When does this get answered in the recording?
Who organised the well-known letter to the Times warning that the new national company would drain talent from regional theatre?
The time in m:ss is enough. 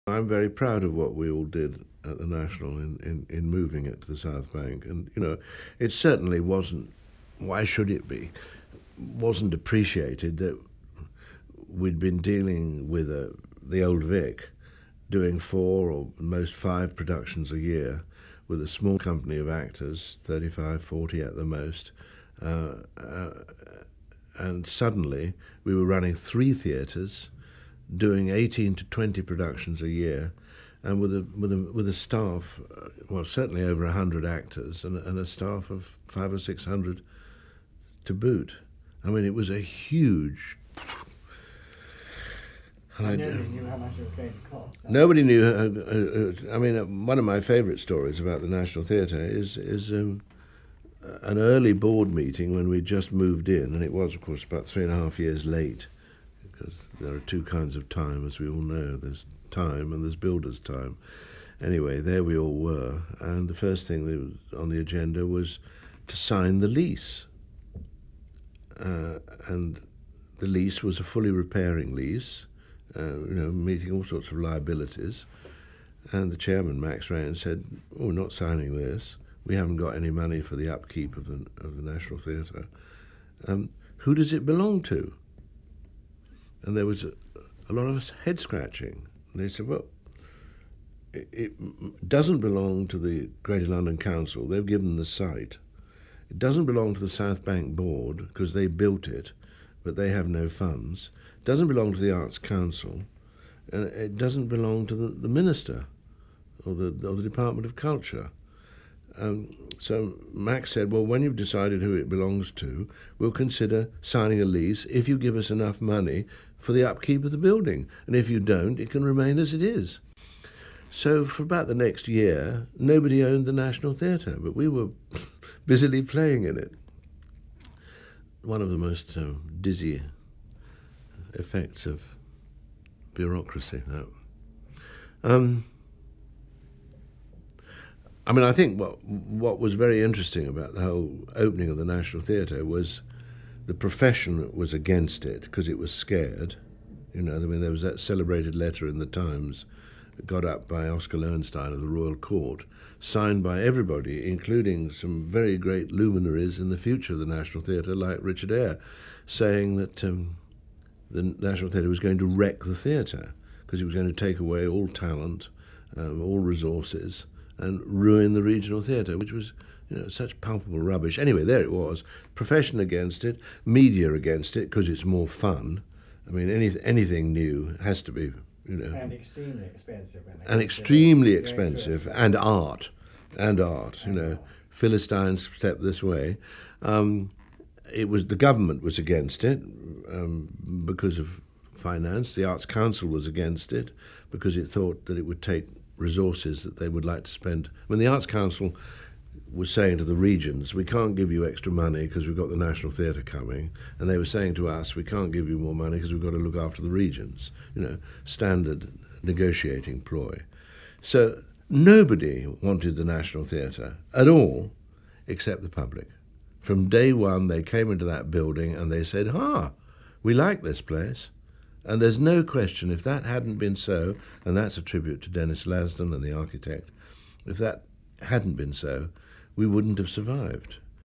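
2:30.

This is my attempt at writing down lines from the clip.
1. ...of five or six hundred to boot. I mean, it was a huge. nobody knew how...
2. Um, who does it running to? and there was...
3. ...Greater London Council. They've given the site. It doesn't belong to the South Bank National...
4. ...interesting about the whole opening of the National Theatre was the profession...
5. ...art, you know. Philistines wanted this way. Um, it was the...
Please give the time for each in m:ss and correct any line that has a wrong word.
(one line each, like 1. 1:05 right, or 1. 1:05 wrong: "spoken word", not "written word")
1. 0:35 right
2. 1:23 wrong: "belong", not "running"
3. 1:33 wrong: "Board", not "National"
4. 2:20 right
5. 3:03 wrong: "stepped", not "wanted".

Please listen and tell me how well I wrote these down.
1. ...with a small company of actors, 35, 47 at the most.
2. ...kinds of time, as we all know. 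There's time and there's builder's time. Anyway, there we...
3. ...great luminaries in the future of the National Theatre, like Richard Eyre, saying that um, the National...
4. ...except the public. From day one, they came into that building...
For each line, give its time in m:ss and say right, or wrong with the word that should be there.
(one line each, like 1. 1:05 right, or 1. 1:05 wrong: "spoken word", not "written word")
1. 0:18 wrong: "40", not "47"
2. 0:57 right
3. 2:35 right
4. 3:35 right.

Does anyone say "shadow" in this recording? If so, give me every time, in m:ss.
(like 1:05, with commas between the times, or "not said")
not said.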